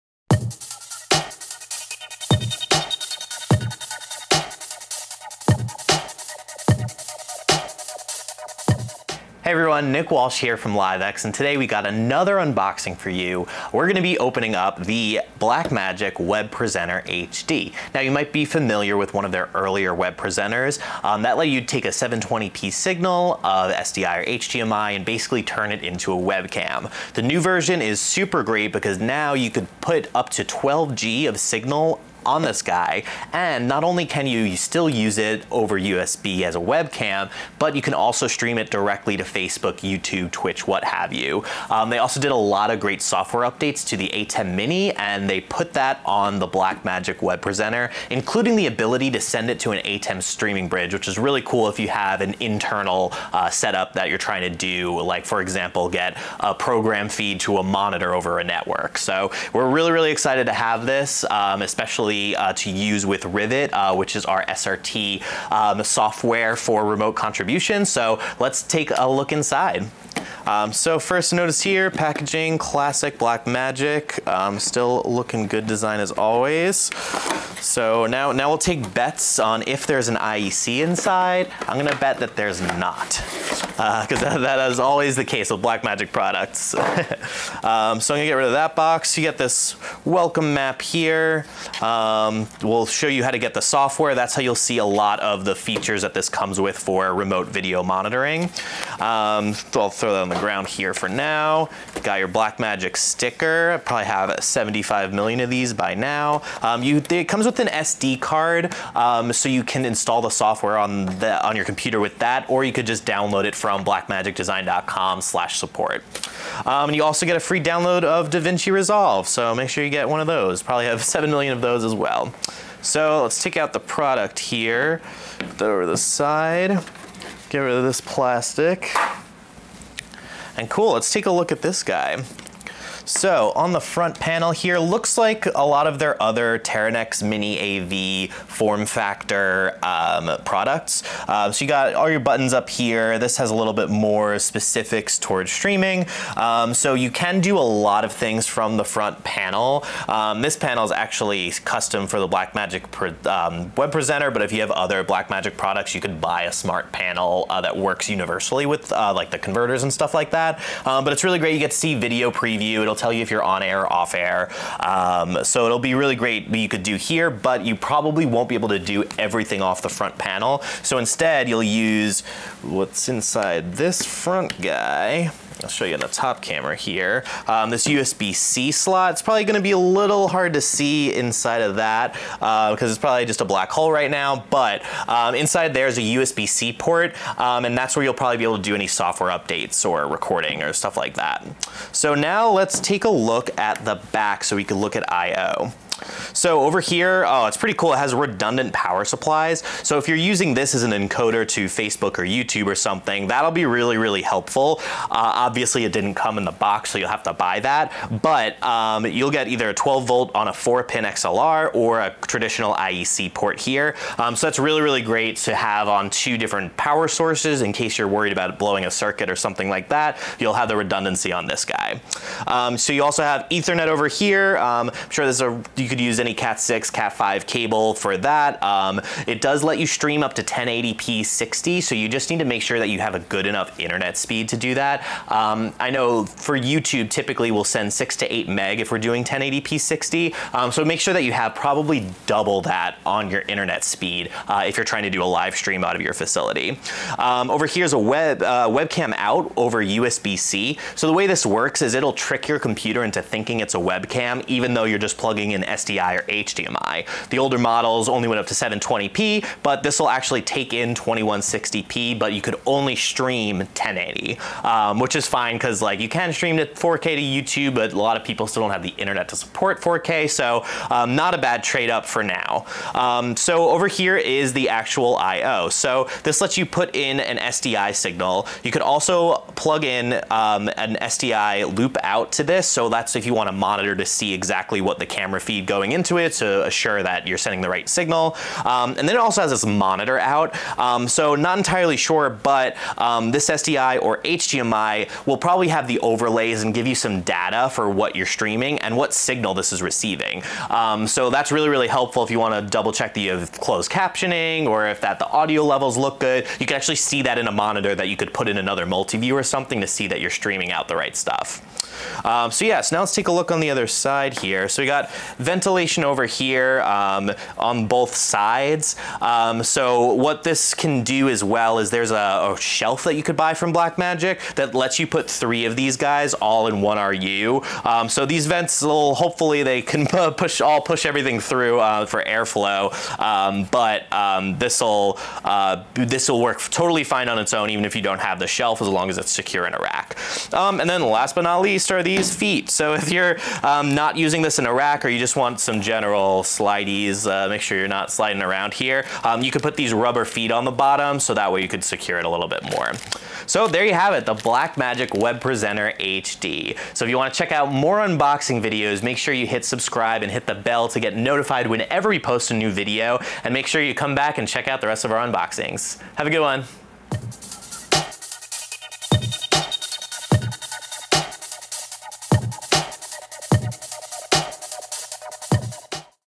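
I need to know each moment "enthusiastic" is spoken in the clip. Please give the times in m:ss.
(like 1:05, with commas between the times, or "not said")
not said.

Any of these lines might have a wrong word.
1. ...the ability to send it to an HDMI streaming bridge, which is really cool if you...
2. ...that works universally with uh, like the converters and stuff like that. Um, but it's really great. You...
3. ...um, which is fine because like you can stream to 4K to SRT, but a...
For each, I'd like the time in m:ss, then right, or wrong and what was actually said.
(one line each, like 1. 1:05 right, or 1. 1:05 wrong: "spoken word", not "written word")
1. 0:48 wrong: "ATEM", not "HDMI"
2. 2:37 right
3. 4:24 wrong: "YouTube", not "SRT".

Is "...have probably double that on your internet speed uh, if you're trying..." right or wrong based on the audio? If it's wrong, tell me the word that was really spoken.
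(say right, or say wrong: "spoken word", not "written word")
right.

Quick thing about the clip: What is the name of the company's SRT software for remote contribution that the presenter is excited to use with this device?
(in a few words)
Rivet.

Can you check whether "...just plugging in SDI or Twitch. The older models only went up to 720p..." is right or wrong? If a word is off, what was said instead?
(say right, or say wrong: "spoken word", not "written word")
wrong: "HDMI", not "Twitch".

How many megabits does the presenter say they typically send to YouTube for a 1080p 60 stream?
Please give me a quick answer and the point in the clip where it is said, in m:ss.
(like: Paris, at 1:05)
6 to 8, at 3:57.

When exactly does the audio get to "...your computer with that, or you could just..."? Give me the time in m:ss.
1:51.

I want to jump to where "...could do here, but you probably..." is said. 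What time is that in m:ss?
2:46.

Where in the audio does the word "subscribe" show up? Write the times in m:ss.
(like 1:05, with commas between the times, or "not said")
5:59.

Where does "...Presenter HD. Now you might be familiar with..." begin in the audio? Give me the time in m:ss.
0:16.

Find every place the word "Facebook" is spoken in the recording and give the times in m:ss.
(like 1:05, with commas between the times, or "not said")
0:39, 3:21.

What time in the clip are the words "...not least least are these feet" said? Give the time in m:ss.
5:41.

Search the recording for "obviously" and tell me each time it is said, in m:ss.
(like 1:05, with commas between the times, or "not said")
3:25.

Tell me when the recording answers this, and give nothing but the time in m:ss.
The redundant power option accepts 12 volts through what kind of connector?
3:30.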